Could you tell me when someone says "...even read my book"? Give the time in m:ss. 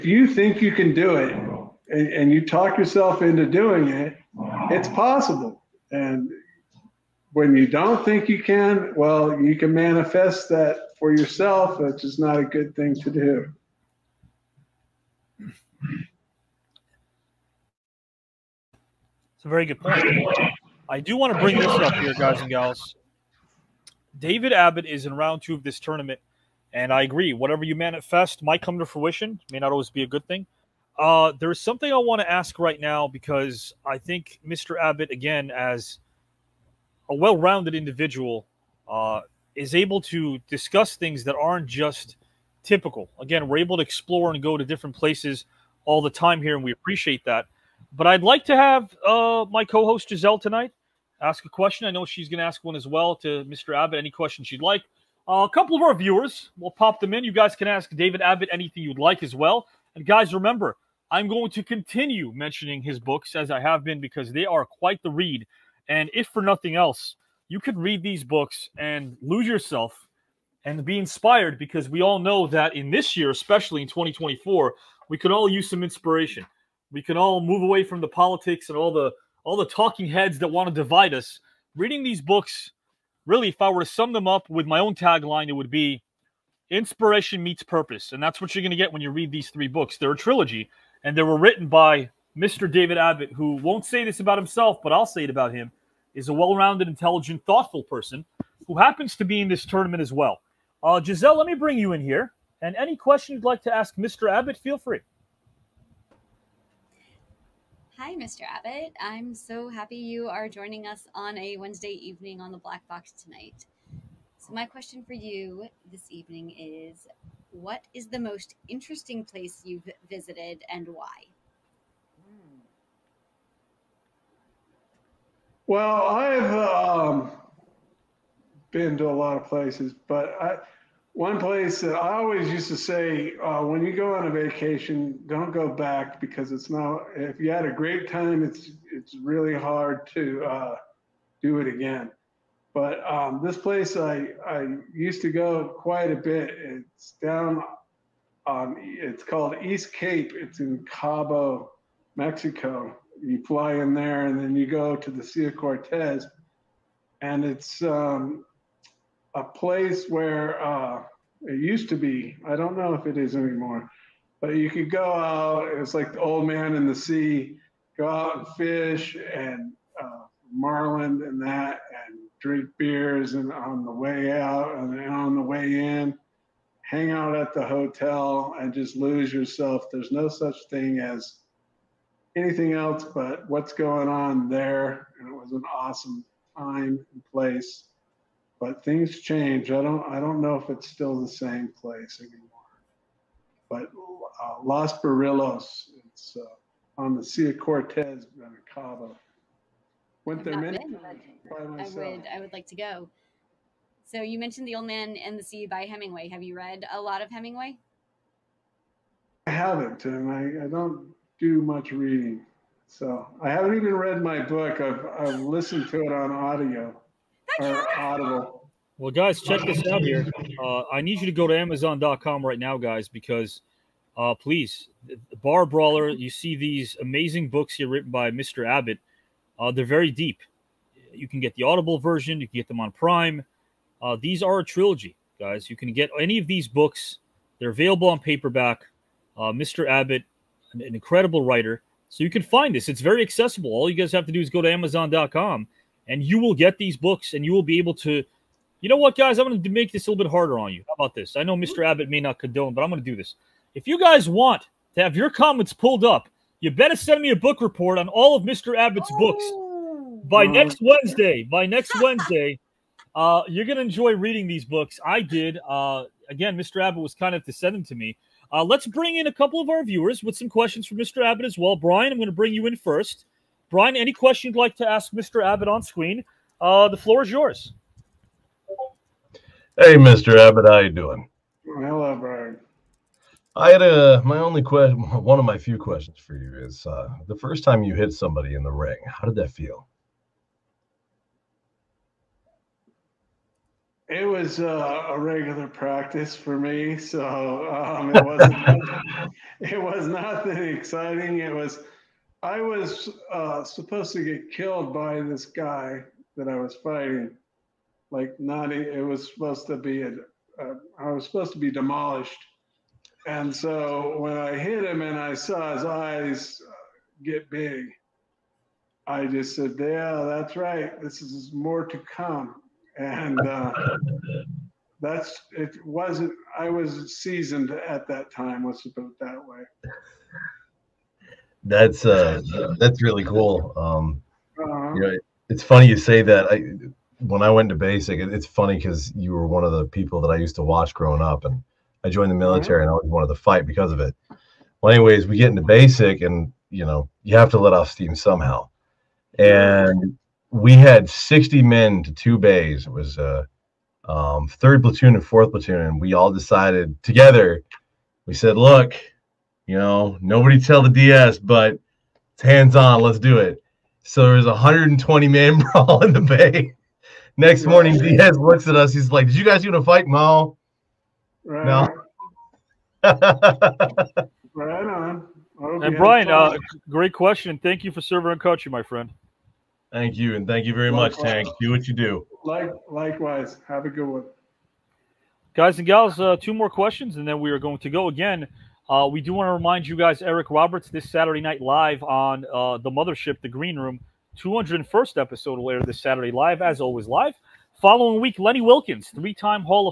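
3:33.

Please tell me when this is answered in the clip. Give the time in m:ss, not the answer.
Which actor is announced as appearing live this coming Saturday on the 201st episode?
6:30.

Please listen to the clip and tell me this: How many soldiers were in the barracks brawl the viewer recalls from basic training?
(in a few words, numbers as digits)
120.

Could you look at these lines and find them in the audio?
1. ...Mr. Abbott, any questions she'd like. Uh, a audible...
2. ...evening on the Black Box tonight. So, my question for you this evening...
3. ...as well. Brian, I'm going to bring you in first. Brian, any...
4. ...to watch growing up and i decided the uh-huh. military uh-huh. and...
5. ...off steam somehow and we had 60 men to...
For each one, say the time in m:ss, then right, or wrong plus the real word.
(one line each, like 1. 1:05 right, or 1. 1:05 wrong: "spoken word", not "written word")
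1. 0:53 wrong: "couple", not "audible"
2. 1:51 right
3. 4:31 right
4. 5:40 wrong: "joined", not "decided"
5. 5:47 right.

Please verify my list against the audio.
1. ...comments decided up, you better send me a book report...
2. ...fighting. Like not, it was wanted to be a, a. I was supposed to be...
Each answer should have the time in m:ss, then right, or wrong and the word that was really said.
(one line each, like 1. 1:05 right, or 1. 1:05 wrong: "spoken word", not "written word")
1. 4:15 wrong: "pulled", not "decided"
2. 5:06 wrong: "supposed", not "wanted".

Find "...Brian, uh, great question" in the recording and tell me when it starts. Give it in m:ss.
6:15.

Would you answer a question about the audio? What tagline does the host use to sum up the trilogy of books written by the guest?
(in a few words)
Inspiration meets purpose.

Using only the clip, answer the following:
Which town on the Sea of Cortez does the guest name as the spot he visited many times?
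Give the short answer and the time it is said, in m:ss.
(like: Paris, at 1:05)
Los Barriles, at 3:14.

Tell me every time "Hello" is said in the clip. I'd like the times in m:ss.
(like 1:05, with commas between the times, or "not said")
4:41.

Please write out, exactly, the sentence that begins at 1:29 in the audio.
They're a trilogy, and they were written by Mr.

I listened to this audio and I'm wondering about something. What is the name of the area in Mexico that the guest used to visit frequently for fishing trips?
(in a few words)
East Cape.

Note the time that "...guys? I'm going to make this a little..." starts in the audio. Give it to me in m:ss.
4:09.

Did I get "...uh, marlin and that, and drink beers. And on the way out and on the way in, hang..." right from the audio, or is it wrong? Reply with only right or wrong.
right.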